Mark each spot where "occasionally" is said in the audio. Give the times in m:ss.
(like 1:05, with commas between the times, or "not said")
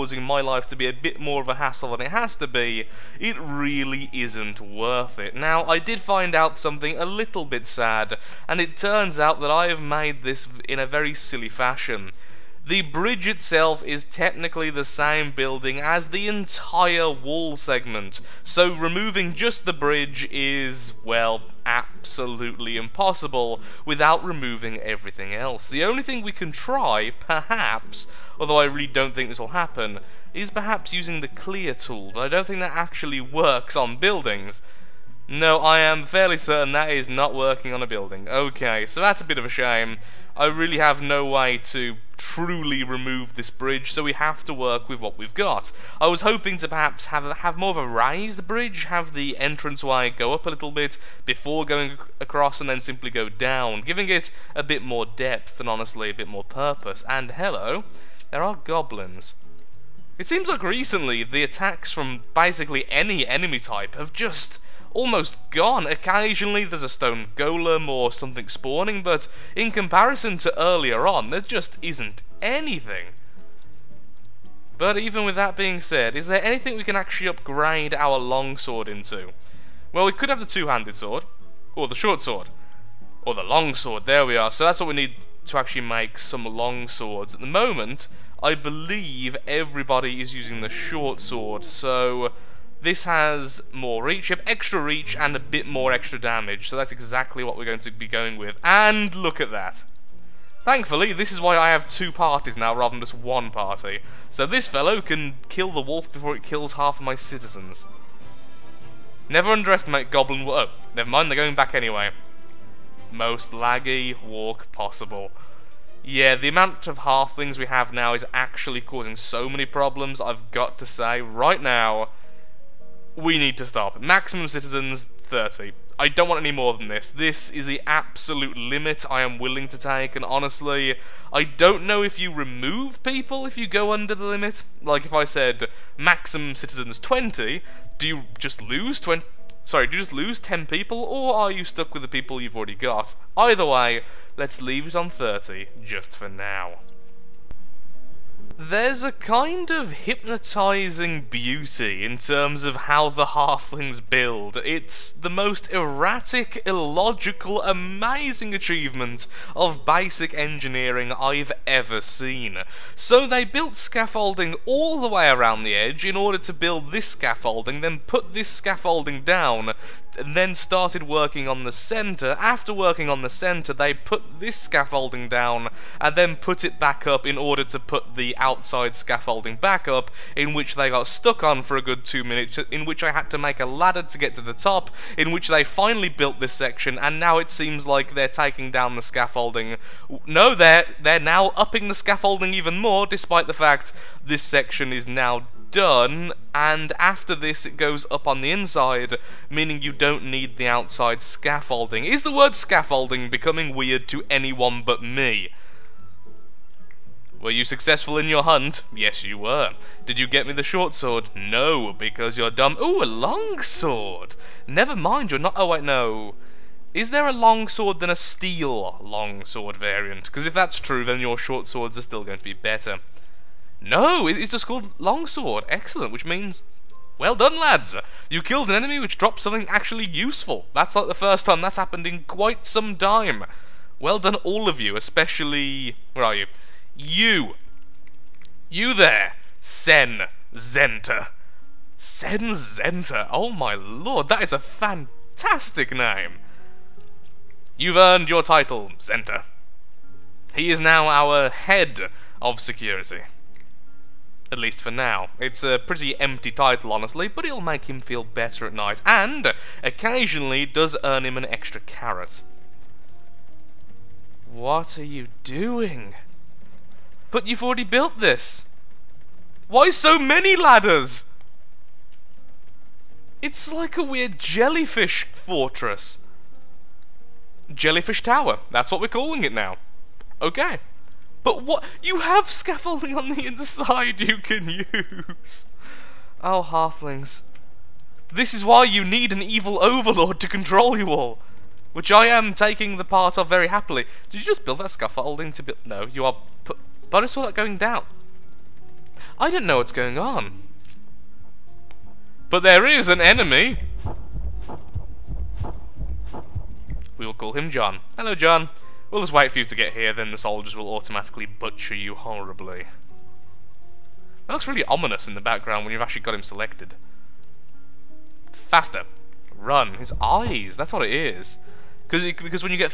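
1:05, 4:19.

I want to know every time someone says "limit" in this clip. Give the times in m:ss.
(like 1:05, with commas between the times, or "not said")
2:08, 2:14.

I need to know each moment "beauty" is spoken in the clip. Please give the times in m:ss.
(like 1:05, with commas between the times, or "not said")
2:31.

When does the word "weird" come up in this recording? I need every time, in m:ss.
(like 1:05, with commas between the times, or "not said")
3:23, 4:34.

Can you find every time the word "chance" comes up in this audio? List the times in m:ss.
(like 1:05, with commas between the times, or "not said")
not said.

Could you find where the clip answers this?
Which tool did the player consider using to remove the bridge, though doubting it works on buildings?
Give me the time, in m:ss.
0:31.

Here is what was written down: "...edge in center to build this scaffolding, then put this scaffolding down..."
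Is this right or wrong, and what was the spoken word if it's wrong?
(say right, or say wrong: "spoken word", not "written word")
wrong: "order", not "center".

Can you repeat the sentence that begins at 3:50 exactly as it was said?
That's like the first time that's happened in quite some time.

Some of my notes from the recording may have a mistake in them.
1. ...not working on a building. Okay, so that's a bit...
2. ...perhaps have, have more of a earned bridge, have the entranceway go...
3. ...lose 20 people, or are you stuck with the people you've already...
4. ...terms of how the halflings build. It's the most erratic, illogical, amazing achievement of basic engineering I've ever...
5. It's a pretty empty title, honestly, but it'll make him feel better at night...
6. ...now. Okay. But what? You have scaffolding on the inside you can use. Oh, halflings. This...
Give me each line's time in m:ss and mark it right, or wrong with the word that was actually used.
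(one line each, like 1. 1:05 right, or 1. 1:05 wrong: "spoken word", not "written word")
1. 0:37 right
2. 0:46 wrong: "raised", not "earned"
3. 2:20 wrong: "10", not "20"
4. 2:32 right
5. 4:15 right
6. 4:39 right.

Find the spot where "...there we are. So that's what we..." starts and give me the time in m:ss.
1:24.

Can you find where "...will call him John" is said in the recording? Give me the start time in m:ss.
5:07.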